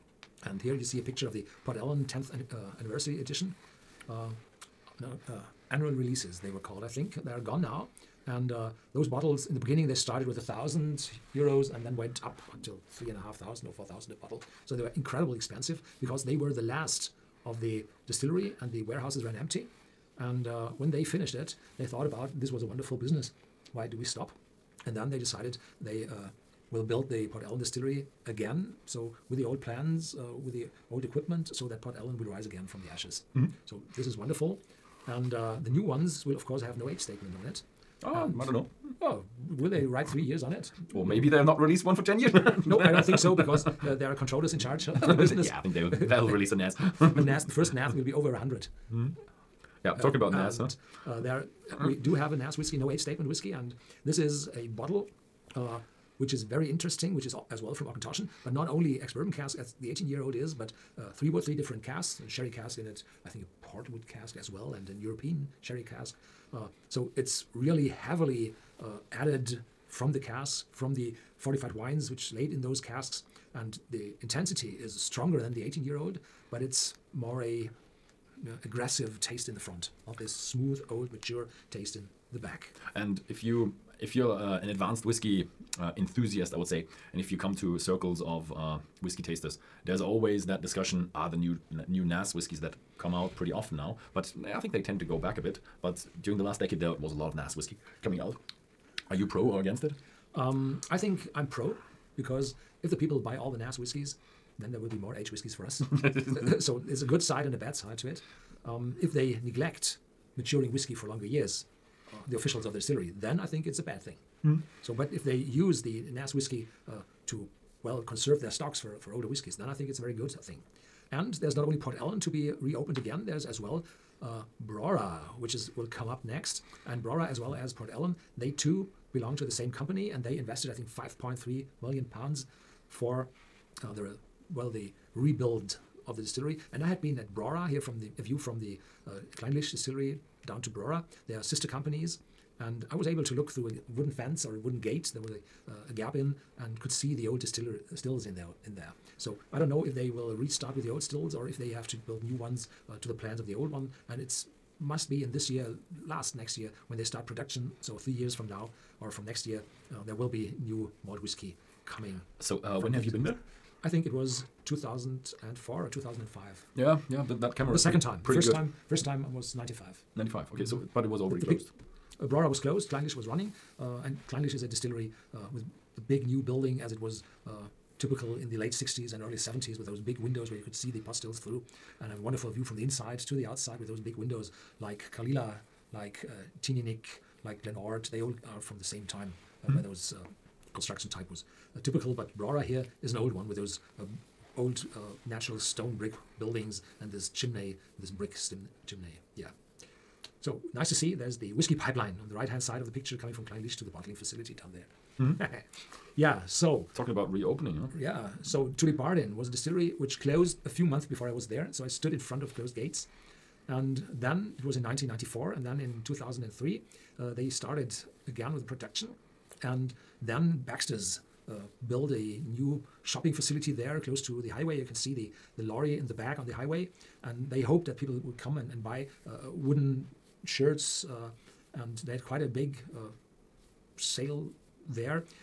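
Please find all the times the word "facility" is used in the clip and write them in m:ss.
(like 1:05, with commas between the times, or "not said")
3:24, 3:43.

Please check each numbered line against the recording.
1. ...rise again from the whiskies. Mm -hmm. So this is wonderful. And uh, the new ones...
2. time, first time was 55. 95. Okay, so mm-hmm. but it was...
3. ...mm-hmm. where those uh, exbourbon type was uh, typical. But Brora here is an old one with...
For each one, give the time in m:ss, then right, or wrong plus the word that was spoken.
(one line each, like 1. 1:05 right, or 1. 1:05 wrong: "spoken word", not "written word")
1. 0:32 wrong: "ashes", not "whiskies"
2. 2:48 wrong: "95", not "55"
3. 3:09 wrong: "construction", not "exbourbon".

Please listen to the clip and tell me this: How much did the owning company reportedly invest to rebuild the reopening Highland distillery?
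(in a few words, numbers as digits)
5.3 million pounds.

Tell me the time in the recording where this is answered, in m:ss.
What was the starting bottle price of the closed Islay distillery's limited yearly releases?
0:10.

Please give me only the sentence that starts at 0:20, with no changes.
And uh, when they finished it, they thought about this was a wonderful business.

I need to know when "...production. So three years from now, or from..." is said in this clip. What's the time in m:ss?
2:37.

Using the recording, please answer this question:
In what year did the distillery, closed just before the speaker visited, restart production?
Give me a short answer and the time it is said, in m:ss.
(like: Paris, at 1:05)
2003, at 3:36.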